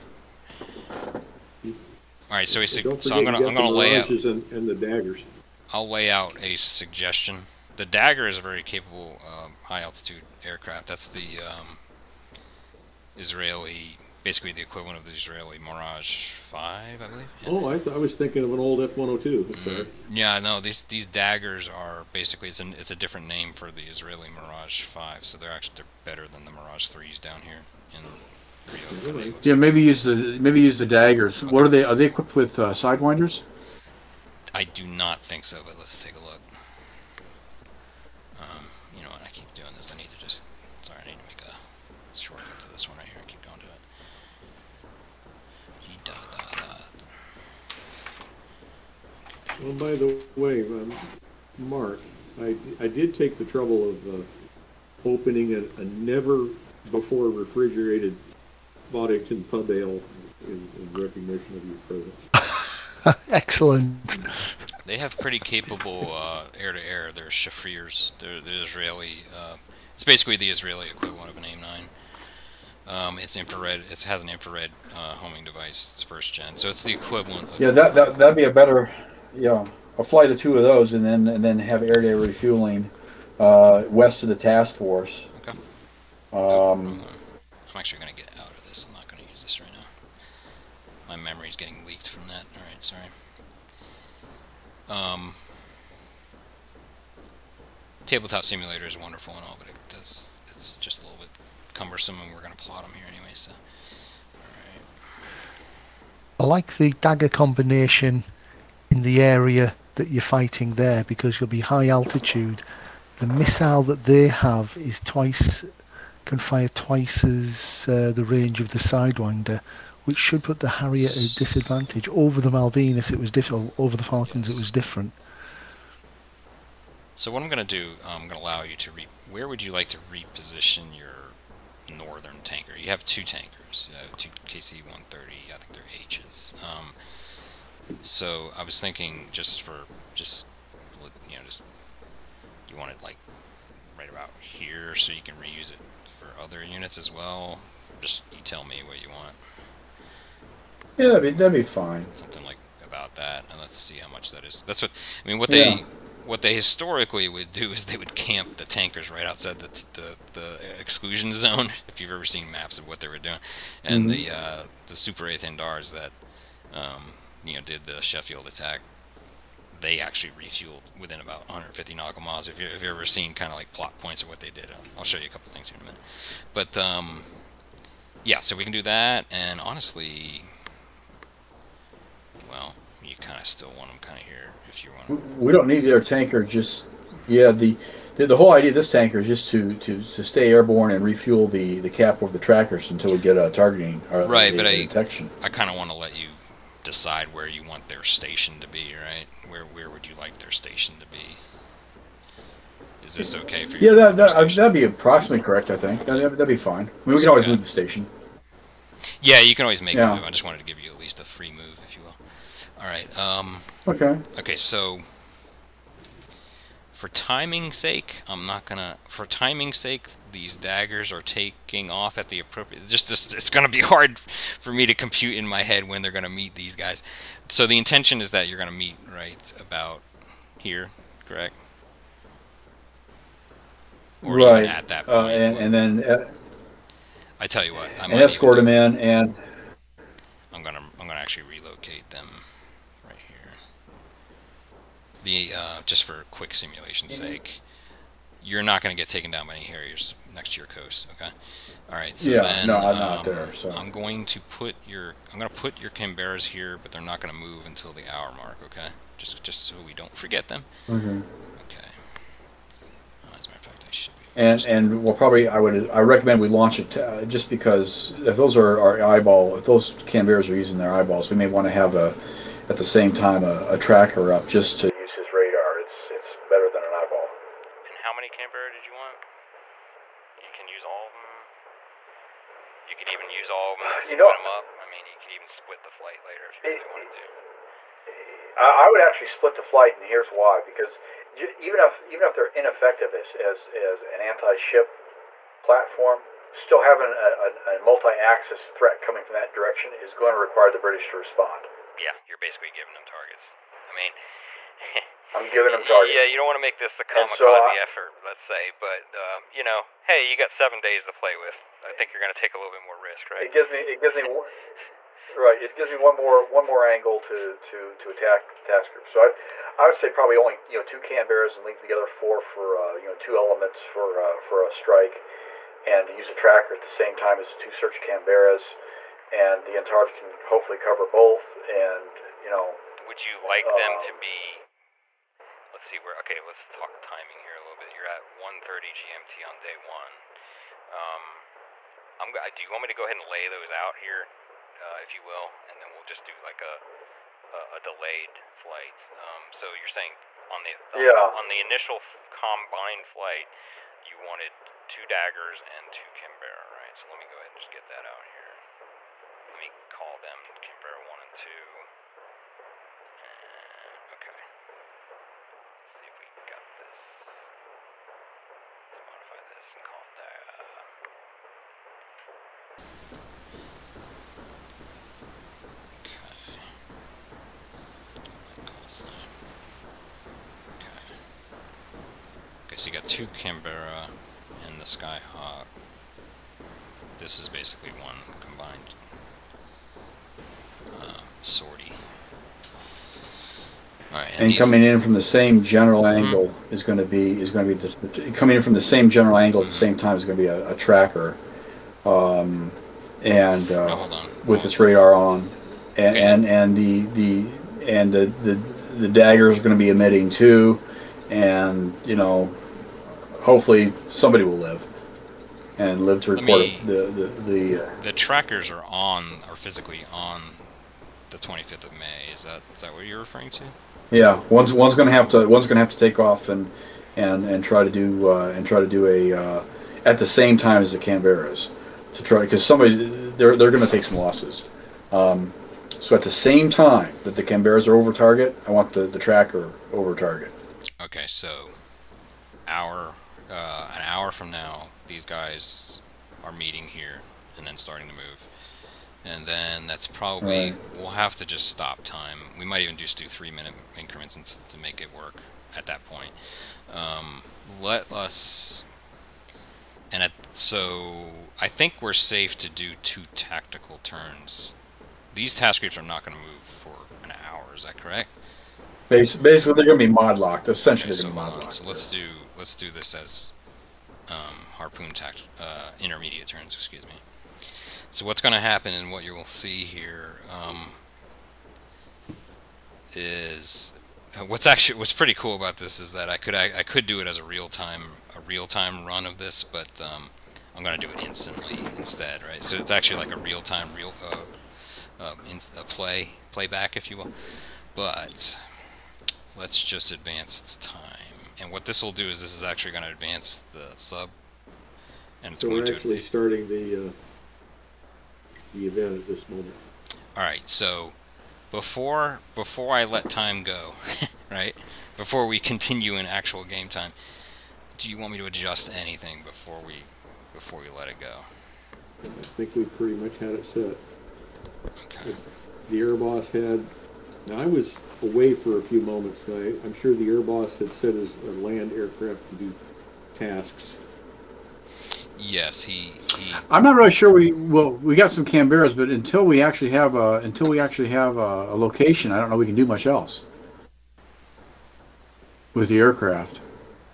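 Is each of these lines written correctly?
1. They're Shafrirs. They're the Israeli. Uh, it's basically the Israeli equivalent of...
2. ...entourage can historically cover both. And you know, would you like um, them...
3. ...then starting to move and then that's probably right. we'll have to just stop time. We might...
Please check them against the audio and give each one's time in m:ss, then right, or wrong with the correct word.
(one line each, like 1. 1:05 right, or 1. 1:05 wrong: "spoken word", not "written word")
1. 1:07 right
2. 5:29 wrong: "hopefully", not "historically"
3. 7:27 right.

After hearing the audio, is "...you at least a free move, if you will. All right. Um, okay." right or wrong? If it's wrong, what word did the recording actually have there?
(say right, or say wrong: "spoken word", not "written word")
right.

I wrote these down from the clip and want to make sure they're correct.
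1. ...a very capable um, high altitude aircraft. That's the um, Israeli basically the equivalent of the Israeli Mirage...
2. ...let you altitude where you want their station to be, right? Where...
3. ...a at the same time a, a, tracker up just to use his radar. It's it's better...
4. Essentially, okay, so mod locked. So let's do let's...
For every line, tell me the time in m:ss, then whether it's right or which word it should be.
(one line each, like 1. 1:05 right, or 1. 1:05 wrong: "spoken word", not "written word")
1. 0:08 right
2. 3:15 wrong: "decide", not "altitude"
3. 4:32 right
4. 7:50 right.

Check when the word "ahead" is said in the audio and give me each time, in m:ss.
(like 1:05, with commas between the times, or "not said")
5:43, 5:57.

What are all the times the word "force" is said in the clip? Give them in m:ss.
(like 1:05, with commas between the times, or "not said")
1:24.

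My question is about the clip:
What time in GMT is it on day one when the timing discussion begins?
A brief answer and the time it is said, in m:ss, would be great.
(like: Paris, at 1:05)
1:30, at 5:38.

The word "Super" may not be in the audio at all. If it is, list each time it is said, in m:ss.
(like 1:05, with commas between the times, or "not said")
2:44.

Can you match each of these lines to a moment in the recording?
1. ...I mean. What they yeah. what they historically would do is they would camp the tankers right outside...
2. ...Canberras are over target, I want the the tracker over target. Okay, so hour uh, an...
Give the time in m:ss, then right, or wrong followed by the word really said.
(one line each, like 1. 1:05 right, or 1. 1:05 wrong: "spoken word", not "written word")
1. 2:35 right
2. 7:17 right.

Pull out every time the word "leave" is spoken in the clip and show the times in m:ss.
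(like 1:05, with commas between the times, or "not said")
5:21.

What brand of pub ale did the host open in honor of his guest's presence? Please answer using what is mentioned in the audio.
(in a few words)
Boddington.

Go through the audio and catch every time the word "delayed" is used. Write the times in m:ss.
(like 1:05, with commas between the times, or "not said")
5:47.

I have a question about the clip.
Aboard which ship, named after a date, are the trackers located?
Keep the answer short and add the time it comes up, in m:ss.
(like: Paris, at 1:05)
25th of May, at 7:01.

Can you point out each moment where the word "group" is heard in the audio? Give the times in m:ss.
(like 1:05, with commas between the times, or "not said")
5:18, 7:45.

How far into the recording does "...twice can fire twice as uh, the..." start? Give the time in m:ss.
1:55.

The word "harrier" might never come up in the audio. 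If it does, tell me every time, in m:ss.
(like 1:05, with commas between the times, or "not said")
2:00, 4:09.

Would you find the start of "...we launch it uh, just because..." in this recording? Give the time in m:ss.
4:26.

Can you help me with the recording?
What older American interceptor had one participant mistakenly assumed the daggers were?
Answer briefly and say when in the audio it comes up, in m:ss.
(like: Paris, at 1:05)
F-102, at 0:18.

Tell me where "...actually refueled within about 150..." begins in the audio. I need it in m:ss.
2:50.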